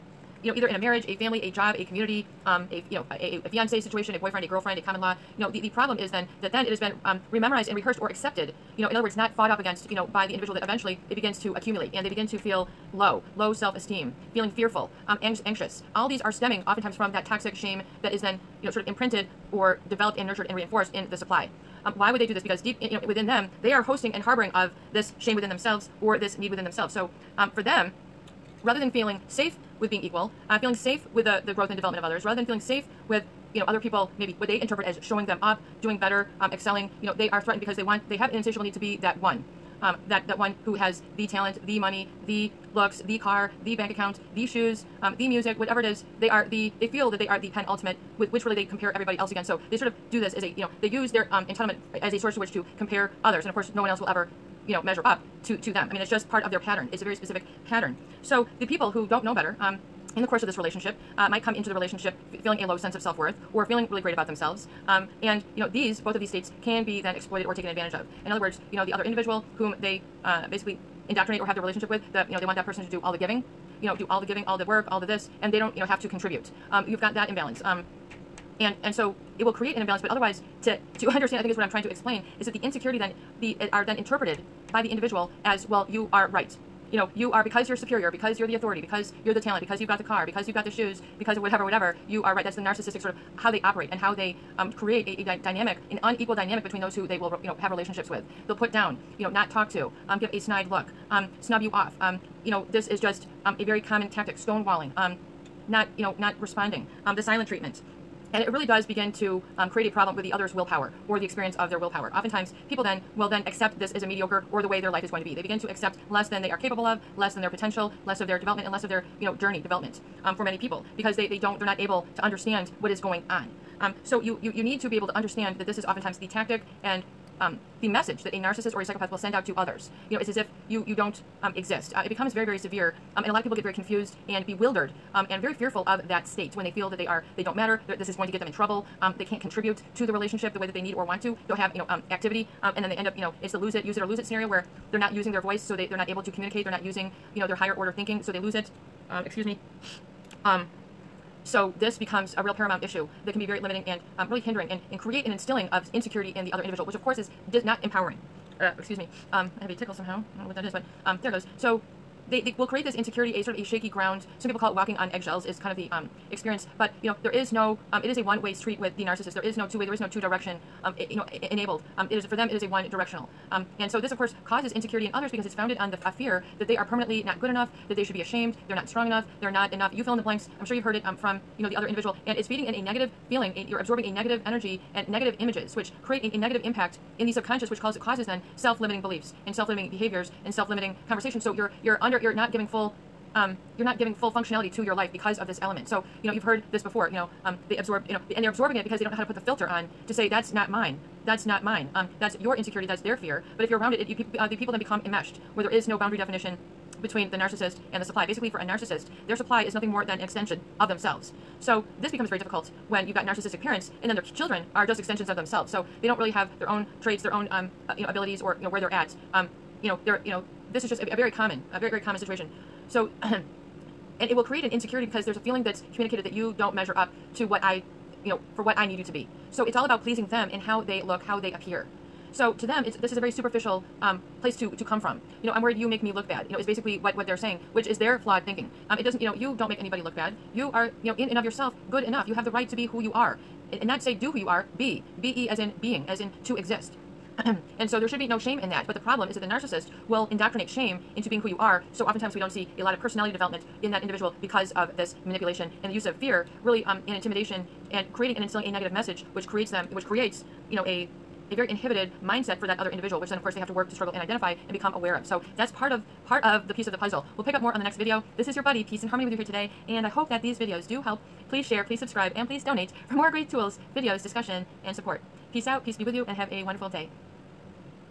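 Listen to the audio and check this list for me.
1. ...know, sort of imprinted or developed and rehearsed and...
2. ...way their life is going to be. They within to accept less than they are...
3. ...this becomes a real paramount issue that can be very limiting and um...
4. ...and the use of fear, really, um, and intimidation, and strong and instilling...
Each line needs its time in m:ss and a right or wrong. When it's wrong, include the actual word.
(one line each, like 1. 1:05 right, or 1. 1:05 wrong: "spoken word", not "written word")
1. 0:18 wrong: "nurtured", not "rehearsed"
2. 1:54 wrong: "begin", not "within"
3. 2:31 right
4. 4:15 wrong: "creating", not "strong".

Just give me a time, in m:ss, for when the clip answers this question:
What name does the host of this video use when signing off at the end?
4:28.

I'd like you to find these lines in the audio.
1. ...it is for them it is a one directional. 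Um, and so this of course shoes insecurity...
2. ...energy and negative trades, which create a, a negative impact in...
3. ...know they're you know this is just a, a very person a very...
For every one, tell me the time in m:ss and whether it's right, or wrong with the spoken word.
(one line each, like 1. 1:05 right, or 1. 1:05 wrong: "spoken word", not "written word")
1. 2:52 wrong: "causes", not "shoes"
2. 3:04 wrong: "images", not "trades"
3. 3:39 wrong: "common", not "person".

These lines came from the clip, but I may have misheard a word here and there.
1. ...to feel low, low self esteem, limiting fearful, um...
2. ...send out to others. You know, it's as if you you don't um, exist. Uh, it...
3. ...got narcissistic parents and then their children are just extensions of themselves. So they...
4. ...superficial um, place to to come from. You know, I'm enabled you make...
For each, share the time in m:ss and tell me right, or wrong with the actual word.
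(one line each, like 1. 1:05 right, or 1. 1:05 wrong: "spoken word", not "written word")
1. 0:12 wrong: "feeling", not "limiting"
2. 2:09 right
3. 3:33 right
4. 3:53 wrong: "worried", not "enabled".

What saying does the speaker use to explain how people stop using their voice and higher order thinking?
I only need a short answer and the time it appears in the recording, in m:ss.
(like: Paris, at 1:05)
use it or lose it, at 2:23.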